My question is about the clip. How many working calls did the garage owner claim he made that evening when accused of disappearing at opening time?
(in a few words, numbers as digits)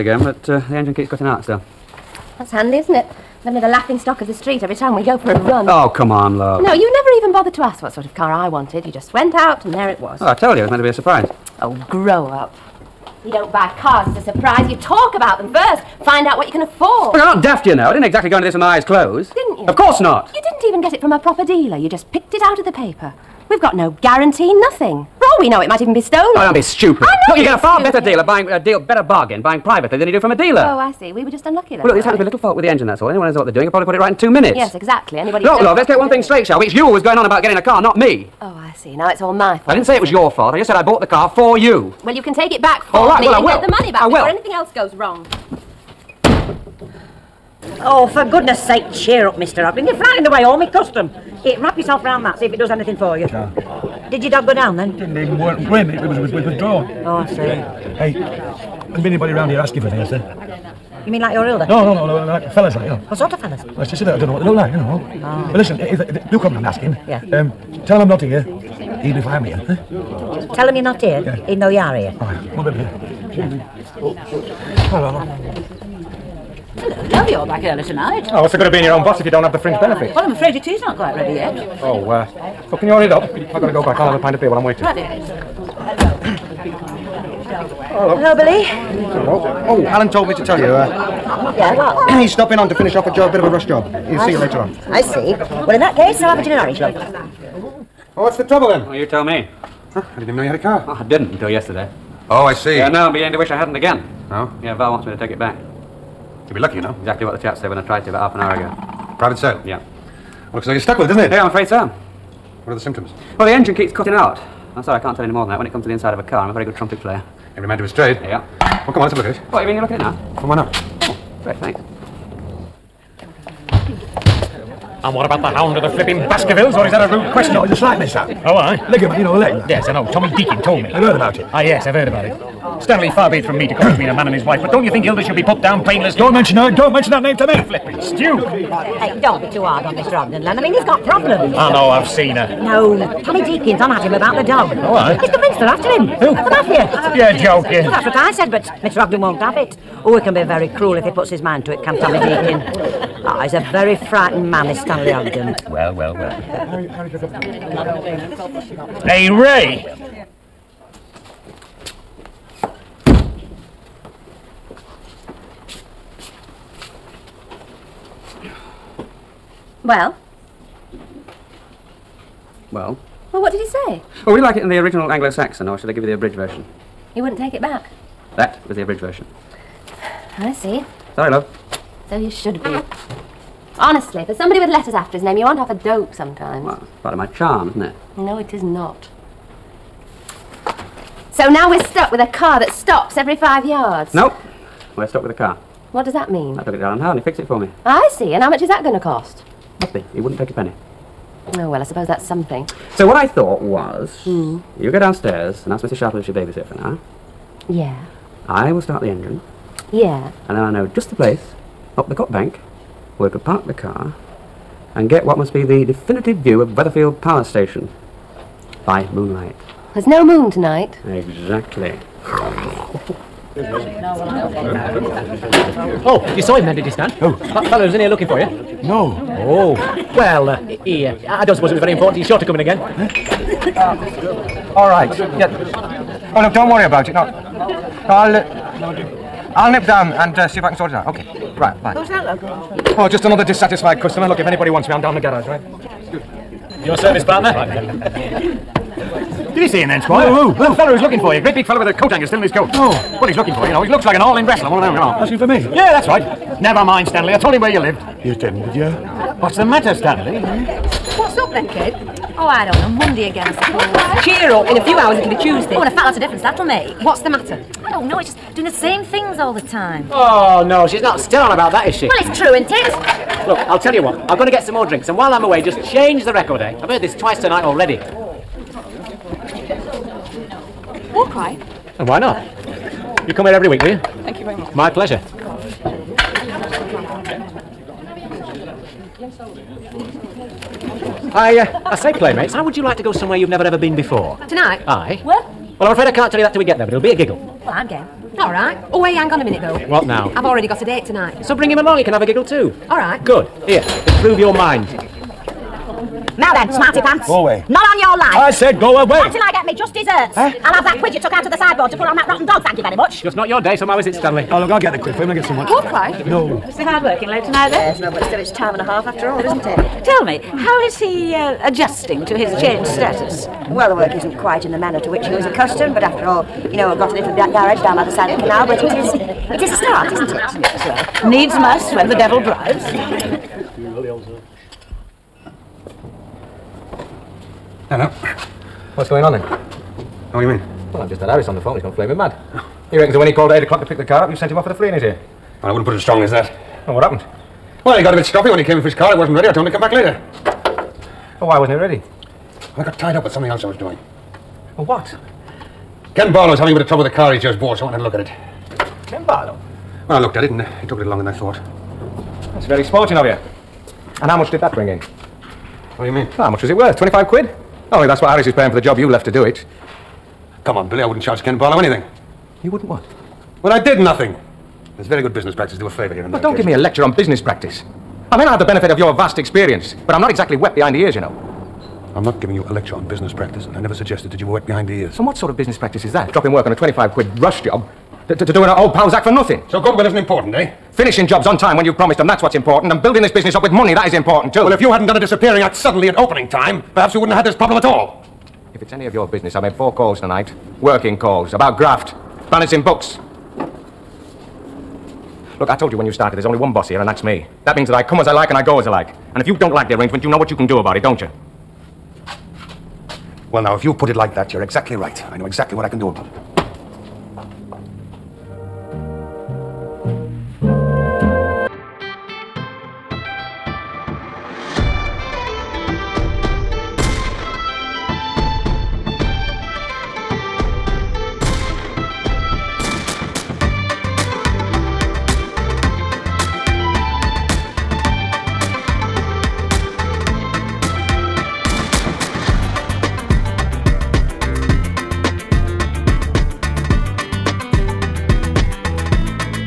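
4.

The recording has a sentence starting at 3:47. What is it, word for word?
Oh, That fellow was in here looking for you?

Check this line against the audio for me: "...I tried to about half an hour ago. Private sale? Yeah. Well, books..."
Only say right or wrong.
wrong.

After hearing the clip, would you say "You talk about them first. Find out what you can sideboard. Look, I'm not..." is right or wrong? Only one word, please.
wrong.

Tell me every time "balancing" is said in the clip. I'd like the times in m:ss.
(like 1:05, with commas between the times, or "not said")
6:42.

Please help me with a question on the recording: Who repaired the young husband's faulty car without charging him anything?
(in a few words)
Alan Howard.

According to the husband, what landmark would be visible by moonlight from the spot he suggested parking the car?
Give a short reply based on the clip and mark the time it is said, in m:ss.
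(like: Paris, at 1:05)
Weatherfield Power Station, at 3:36.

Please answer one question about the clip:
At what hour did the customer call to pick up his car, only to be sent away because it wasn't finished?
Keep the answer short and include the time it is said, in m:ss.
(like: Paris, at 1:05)
8 o'clock, at 5:43.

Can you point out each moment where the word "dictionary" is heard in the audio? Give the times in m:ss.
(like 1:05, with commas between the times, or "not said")
not said.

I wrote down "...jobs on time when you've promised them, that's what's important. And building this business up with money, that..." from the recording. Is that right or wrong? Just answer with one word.
right.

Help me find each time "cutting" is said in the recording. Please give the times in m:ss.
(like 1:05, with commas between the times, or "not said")
0:01, 1:53.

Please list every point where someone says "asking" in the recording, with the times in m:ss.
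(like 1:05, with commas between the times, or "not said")
0:59, 1:06, 4:15.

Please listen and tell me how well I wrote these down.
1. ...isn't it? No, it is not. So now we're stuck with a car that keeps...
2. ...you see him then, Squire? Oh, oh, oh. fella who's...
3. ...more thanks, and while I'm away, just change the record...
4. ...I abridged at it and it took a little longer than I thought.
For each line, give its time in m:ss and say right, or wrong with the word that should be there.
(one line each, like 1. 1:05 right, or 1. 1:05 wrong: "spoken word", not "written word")
1. 3:07 wrong: "stops", not "keeps"
2. 4:09 right
3. 4:34 wrong: "drinks", not "thanks"
4. 6:00 wrong: "looked", not "abridged".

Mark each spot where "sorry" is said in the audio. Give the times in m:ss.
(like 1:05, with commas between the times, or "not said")
1:54, 3:01.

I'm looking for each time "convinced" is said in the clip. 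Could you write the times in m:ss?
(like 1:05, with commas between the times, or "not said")
2:25.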